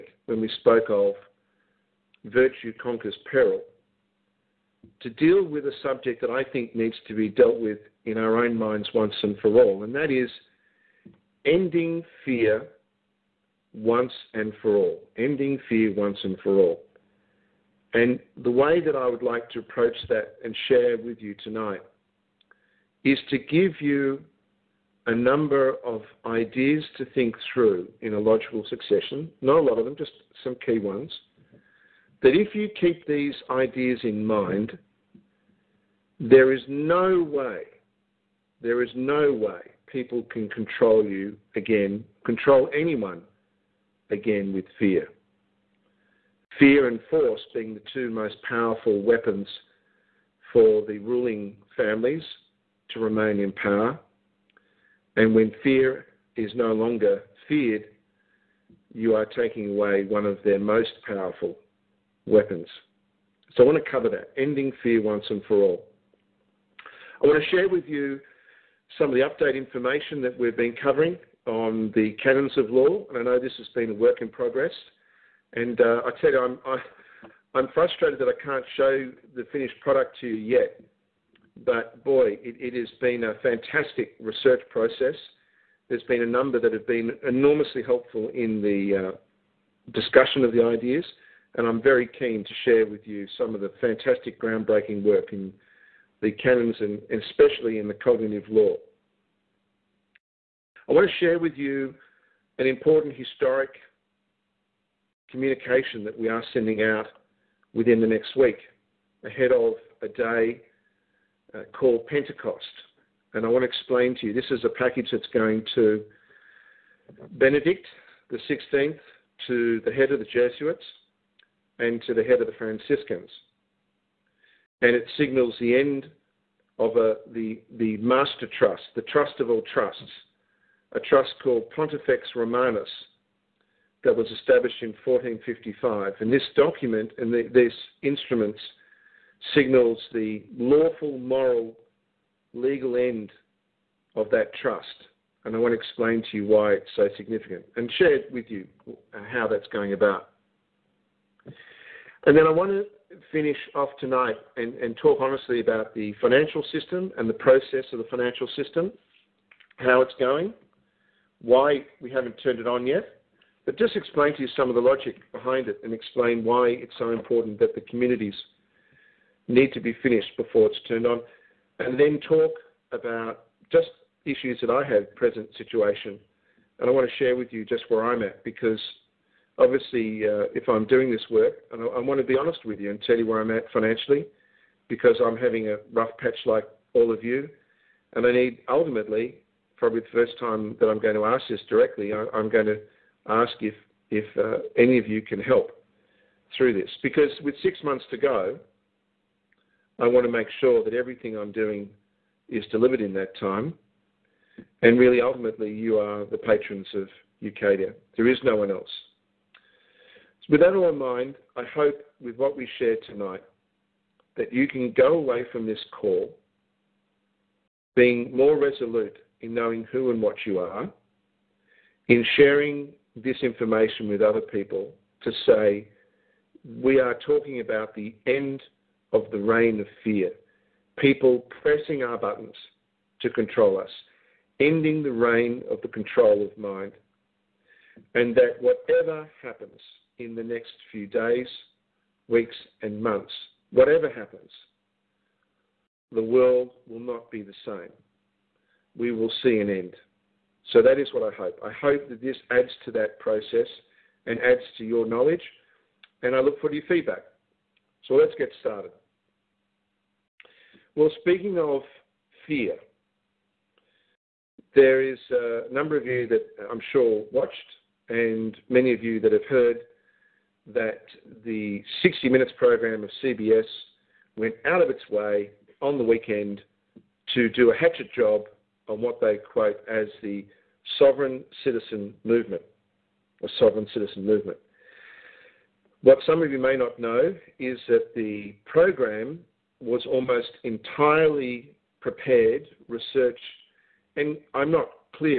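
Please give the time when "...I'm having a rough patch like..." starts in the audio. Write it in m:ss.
3:05.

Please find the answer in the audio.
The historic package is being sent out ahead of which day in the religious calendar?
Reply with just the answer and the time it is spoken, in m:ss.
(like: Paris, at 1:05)
Pentecost, at 1:52.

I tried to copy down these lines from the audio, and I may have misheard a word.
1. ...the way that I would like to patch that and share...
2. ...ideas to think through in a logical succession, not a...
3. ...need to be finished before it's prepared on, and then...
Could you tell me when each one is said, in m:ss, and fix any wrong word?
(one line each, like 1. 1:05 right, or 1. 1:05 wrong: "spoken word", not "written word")
1. 0:18 wrong: "approach", not "patch"
2. 0:26 right
3. 2:49 wrong: "turned", not "prepared".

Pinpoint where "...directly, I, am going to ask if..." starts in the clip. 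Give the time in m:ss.
3:11.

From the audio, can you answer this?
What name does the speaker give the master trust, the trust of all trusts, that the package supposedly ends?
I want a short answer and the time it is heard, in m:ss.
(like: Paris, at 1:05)
Pontifex Romanus, at 2:11.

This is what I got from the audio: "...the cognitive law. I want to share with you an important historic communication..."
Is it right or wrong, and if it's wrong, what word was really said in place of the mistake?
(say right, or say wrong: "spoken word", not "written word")
right.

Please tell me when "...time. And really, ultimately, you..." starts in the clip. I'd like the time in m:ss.
3:23.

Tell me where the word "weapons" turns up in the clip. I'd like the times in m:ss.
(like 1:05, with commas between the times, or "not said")
0:48, 1:02.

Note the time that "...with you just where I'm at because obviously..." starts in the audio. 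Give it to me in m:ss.
2:57.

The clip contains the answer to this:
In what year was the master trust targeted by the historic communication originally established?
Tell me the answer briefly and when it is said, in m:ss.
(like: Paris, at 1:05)
1455, at 2:15.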